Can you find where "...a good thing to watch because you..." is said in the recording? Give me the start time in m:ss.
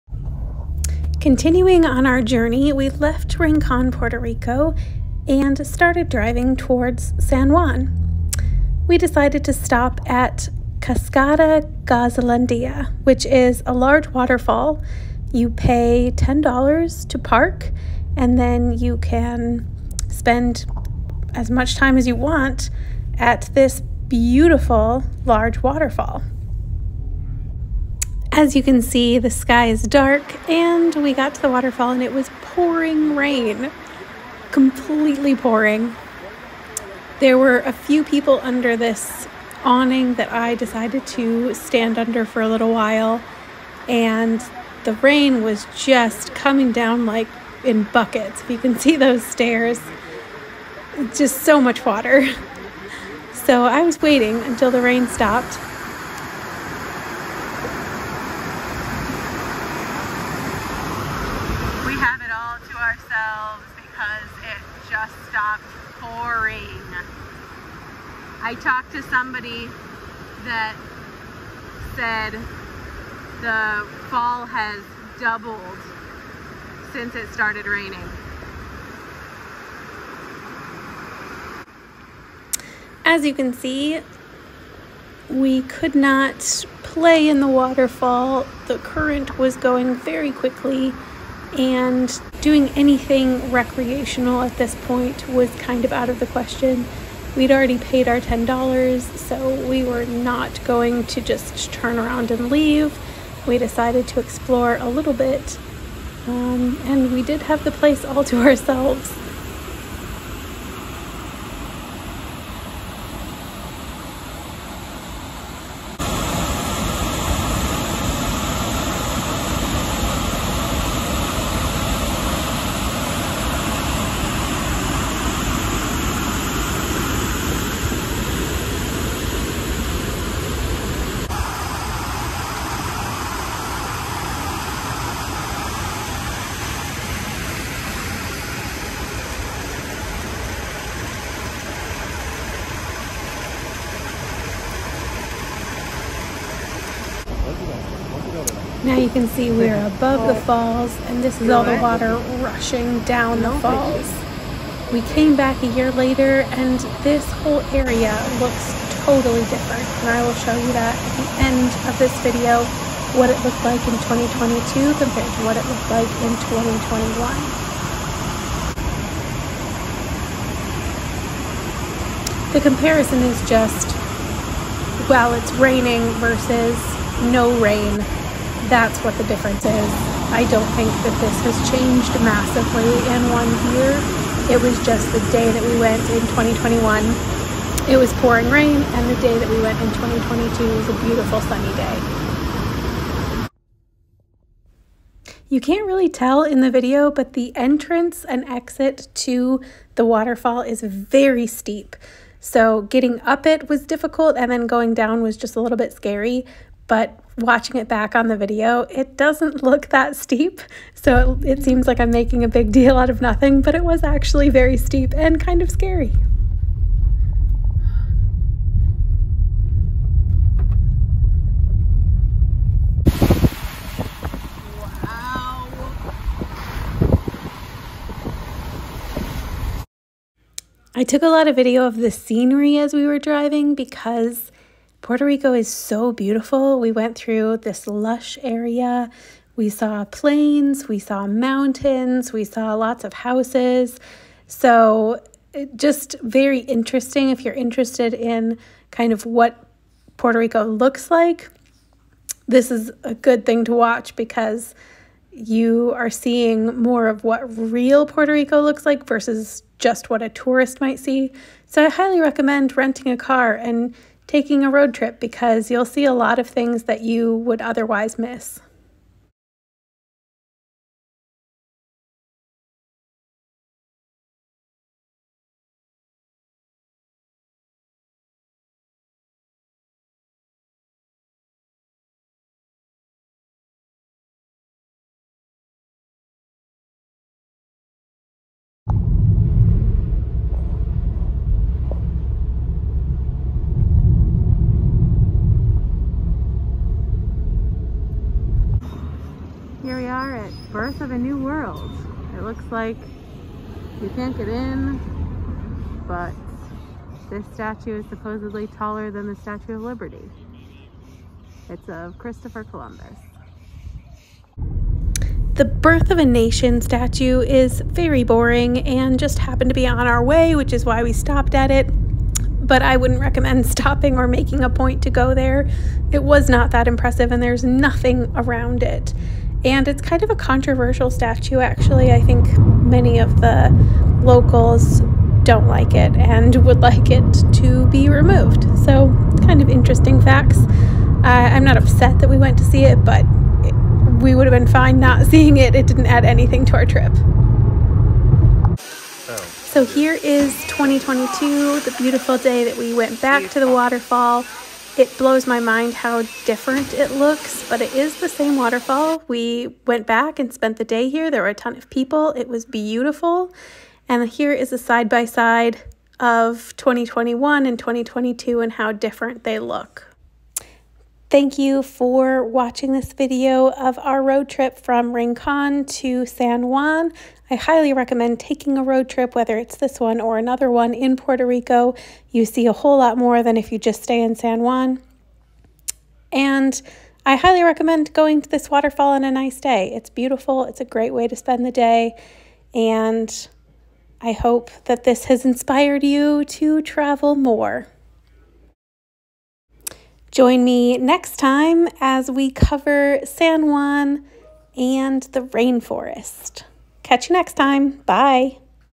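4:13.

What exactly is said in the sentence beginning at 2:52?
the comparison is just well it's raining versus no rain that's what the difference is.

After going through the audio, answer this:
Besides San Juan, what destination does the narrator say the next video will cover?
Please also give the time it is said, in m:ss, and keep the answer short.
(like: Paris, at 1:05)
the rainforest, at 6:45.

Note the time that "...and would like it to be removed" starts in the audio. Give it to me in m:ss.
5:36.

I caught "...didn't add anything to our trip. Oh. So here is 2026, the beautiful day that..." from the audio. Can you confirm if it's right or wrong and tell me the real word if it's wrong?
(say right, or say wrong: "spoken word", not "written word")
wrong: "2022", not "2026".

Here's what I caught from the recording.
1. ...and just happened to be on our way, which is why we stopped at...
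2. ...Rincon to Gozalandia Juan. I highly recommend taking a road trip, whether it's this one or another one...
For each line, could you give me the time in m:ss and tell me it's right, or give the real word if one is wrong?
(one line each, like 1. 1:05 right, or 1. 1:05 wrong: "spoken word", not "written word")
1. 5:18 right
2. 6:15 wrong: "San", not "Gozalandia".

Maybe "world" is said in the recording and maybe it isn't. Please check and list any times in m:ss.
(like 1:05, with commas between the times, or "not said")
5:01.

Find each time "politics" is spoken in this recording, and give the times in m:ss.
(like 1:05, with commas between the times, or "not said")
not said.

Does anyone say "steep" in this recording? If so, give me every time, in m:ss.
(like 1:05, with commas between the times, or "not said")
3:21, 3:30, 3:34.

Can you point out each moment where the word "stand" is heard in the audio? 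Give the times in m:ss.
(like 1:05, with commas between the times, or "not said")
0:41.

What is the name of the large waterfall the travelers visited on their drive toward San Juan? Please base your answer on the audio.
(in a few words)
Cascada Gozalandia.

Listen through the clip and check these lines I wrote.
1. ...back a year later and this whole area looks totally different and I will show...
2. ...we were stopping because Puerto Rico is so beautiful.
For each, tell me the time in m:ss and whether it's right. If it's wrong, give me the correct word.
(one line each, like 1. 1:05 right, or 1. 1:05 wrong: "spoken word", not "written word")
1. 2:35 right
2. 3:52 wrong: "driving", not "stopping".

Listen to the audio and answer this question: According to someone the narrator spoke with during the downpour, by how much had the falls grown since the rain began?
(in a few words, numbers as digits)
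doubled.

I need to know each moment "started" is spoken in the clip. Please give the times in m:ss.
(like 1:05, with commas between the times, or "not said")
0:05, 1:17.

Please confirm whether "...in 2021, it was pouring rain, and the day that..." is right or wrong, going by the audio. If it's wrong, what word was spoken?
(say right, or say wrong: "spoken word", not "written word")
right.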